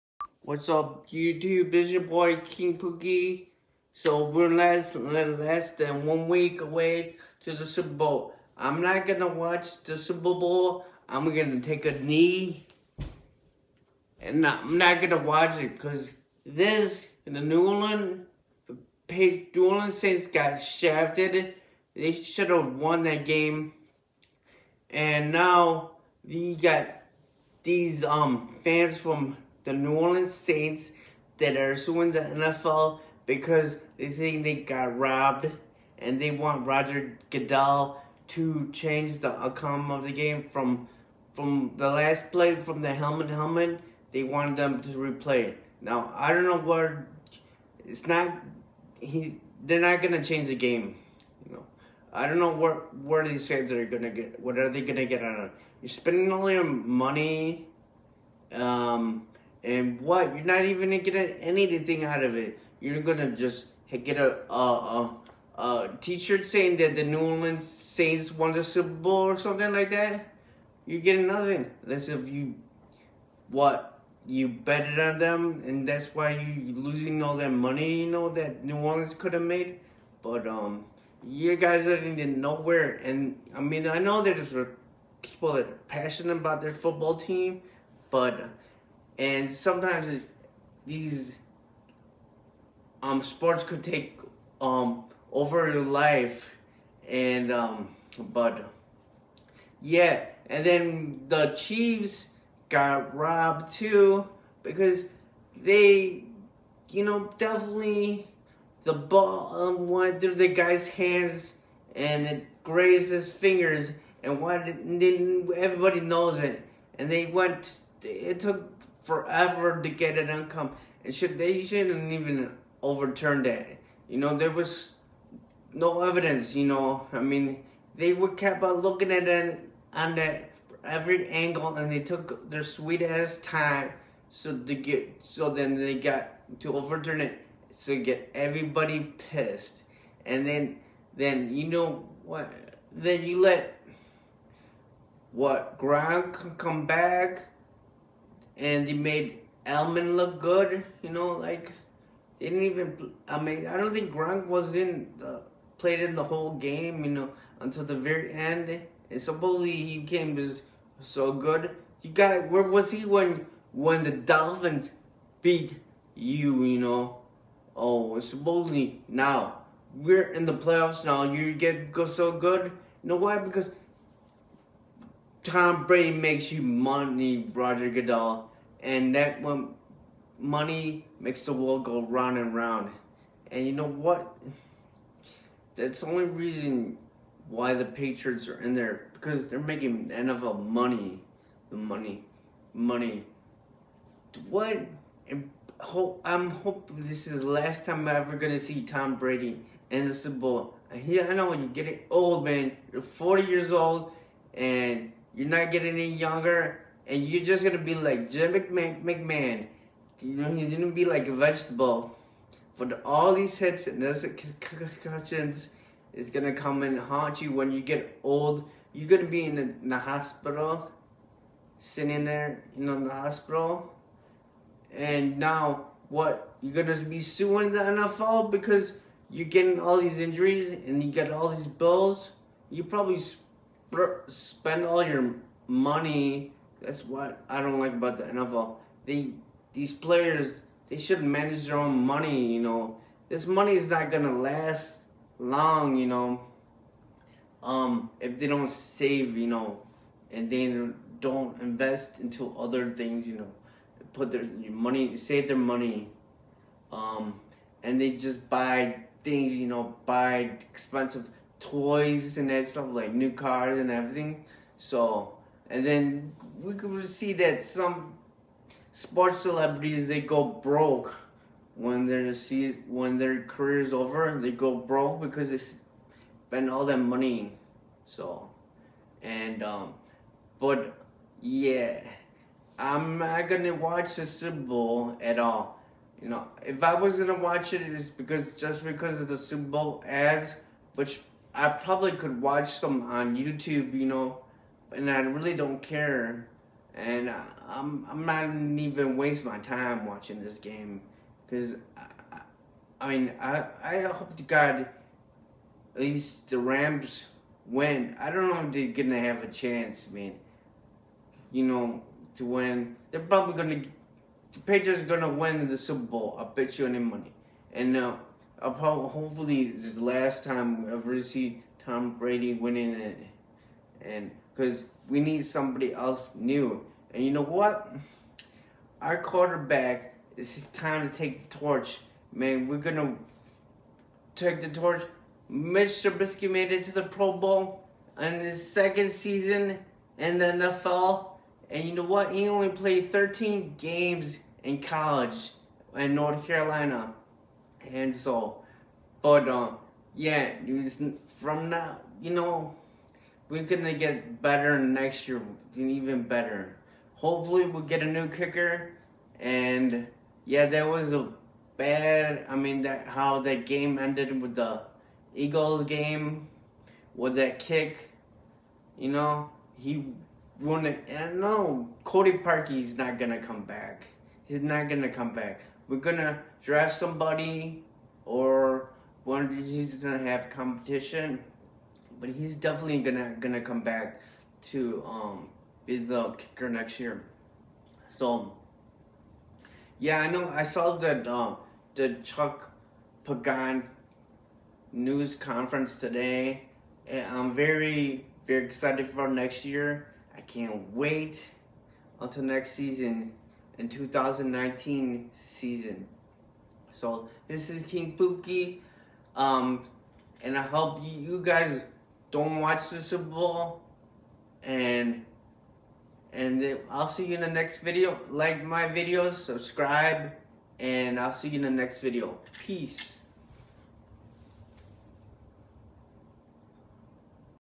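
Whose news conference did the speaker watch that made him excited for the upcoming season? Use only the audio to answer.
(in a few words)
Chuck Pagano.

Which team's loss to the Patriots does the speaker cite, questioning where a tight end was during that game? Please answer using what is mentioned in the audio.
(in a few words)
Dolphins.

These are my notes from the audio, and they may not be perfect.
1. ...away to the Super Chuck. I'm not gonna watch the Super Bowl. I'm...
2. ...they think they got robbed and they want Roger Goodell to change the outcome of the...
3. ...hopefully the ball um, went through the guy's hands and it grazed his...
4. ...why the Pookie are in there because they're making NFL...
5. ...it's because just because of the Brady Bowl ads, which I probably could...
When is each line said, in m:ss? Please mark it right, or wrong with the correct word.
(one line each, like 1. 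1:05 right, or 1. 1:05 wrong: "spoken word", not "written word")
1. 0:06 wrong: "Bowl", not "Chuck"
2. 0:33 right
3. 1:47 wrong: "definitely", not "hopefully"
4. 3:07 wrong: "Patriots", not "Pookie"
5. 4:47 wrong: "Super", not "Brady".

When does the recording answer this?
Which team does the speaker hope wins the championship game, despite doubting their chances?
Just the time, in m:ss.
5:06.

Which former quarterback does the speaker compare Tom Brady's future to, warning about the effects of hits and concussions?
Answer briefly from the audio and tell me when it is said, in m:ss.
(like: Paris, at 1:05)
Jim McMahon, at 3:28.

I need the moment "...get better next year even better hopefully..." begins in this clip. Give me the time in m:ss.
5:53.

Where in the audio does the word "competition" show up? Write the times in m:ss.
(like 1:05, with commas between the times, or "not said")
6:20.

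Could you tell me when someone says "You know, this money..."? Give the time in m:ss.
4:02.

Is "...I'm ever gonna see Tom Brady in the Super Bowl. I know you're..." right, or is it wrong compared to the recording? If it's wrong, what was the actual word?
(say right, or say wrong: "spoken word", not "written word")
right.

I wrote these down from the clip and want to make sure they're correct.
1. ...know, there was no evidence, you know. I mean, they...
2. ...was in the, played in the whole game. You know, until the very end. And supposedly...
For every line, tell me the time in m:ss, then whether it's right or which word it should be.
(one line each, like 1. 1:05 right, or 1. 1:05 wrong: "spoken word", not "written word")
1. 2:04 right
2. 2:34 right.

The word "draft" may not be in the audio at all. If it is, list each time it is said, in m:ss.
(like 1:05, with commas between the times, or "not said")
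6:16.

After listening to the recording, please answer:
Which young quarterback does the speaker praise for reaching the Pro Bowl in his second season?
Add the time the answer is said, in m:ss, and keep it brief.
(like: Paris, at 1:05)
Mitch Trubisky, at 5:35.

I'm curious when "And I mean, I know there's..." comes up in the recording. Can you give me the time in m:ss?
1:23.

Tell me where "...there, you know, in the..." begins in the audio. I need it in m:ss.
3:42.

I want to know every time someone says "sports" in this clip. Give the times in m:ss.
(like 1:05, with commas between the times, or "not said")
1:33, 4:28.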